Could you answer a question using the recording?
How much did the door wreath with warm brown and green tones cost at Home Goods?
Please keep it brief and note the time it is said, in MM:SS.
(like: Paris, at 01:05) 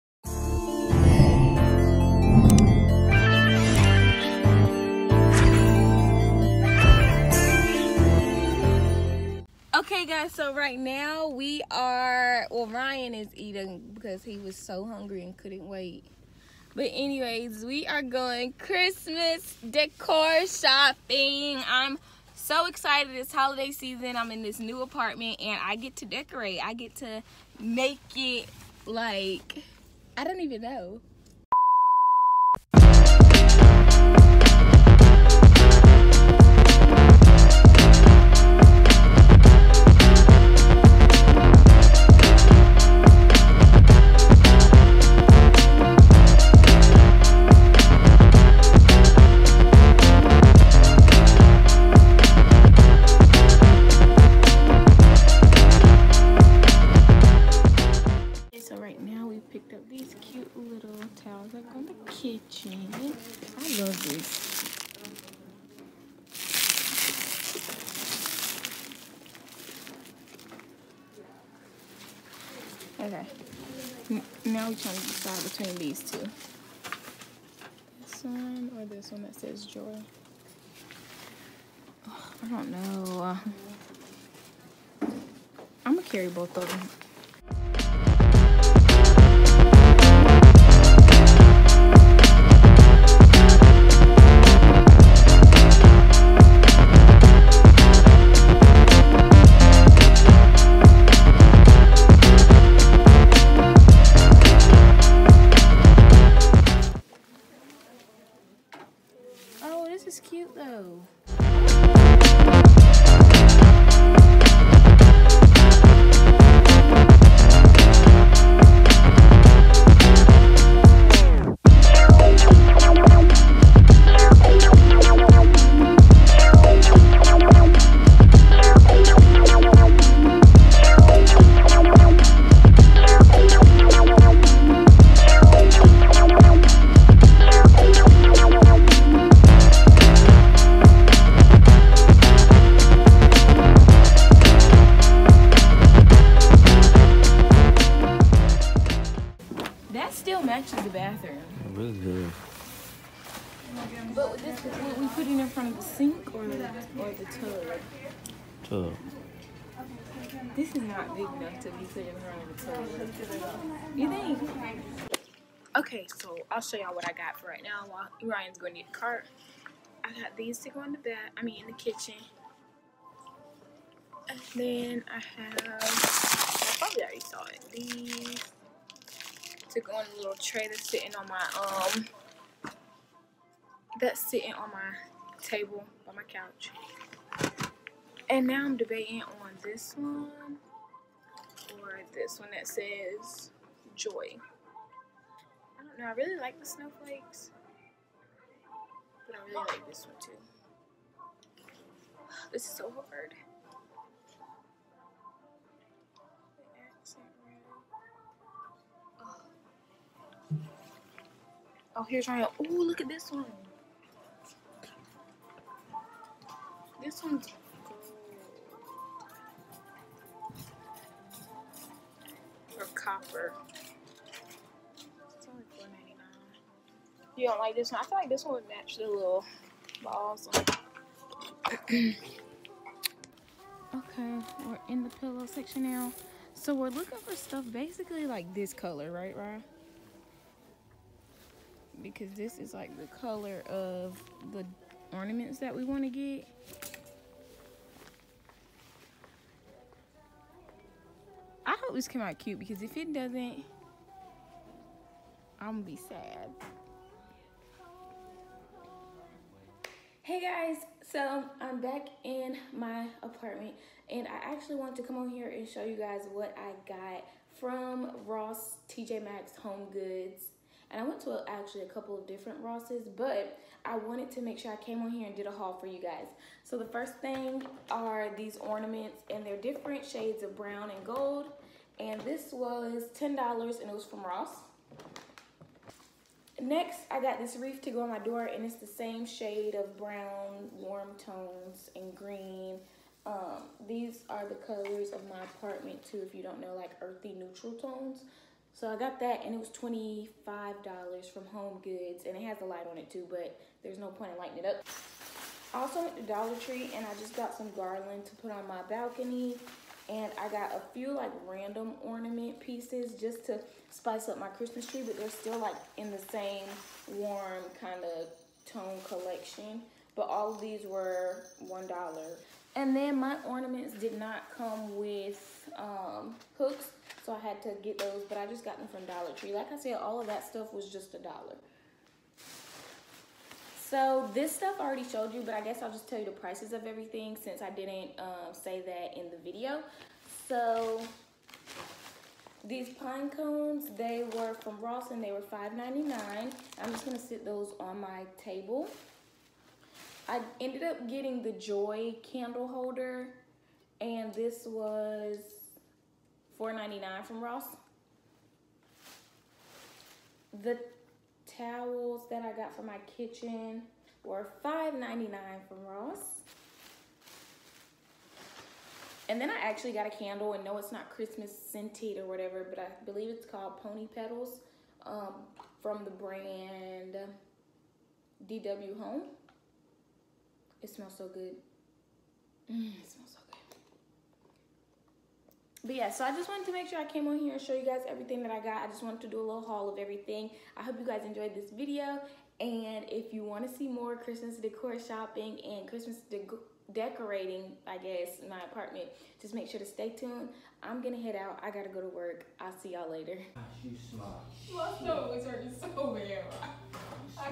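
$25, at 04:59.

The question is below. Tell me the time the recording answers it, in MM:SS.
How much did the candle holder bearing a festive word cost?
05:56.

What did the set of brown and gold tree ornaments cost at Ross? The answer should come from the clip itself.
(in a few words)
$10.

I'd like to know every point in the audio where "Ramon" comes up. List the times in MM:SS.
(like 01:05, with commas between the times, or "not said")
not said.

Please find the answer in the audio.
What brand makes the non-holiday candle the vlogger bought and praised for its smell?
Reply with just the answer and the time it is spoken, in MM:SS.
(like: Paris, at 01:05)
DW Home, at 06:18.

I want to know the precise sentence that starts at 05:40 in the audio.
So these pine cones, they were from Ross and they were $5.99.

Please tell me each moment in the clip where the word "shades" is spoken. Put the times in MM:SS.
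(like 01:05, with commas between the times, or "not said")
04:40, 04:49.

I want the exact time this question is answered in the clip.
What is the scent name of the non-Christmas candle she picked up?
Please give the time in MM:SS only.
06:13.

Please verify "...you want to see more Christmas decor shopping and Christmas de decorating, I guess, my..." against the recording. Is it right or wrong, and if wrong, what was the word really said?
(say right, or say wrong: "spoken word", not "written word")
right.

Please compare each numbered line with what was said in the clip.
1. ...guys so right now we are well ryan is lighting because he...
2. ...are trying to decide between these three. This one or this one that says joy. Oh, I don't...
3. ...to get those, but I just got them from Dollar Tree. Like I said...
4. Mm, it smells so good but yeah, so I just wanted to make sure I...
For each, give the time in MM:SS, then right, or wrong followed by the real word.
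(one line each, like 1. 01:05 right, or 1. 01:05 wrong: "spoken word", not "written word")
1. 00:10 wrong: "eating", not "lighting"
2. 01:14 wrong: "two", not "three"
3. 05:27 right
4. 06:22 right.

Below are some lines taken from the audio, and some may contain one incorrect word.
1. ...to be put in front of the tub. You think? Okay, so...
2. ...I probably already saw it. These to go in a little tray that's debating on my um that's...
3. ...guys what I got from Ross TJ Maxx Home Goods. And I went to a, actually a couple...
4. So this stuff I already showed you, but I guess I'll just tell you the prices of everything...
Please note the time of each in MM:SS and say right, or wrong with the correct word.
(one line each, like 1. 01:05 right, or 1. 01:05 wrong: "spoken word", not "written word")
1. 02:41 right
2. 02:56 wrong: "sitting", not "debating"
3. 04:25 right
4. 05:33 right.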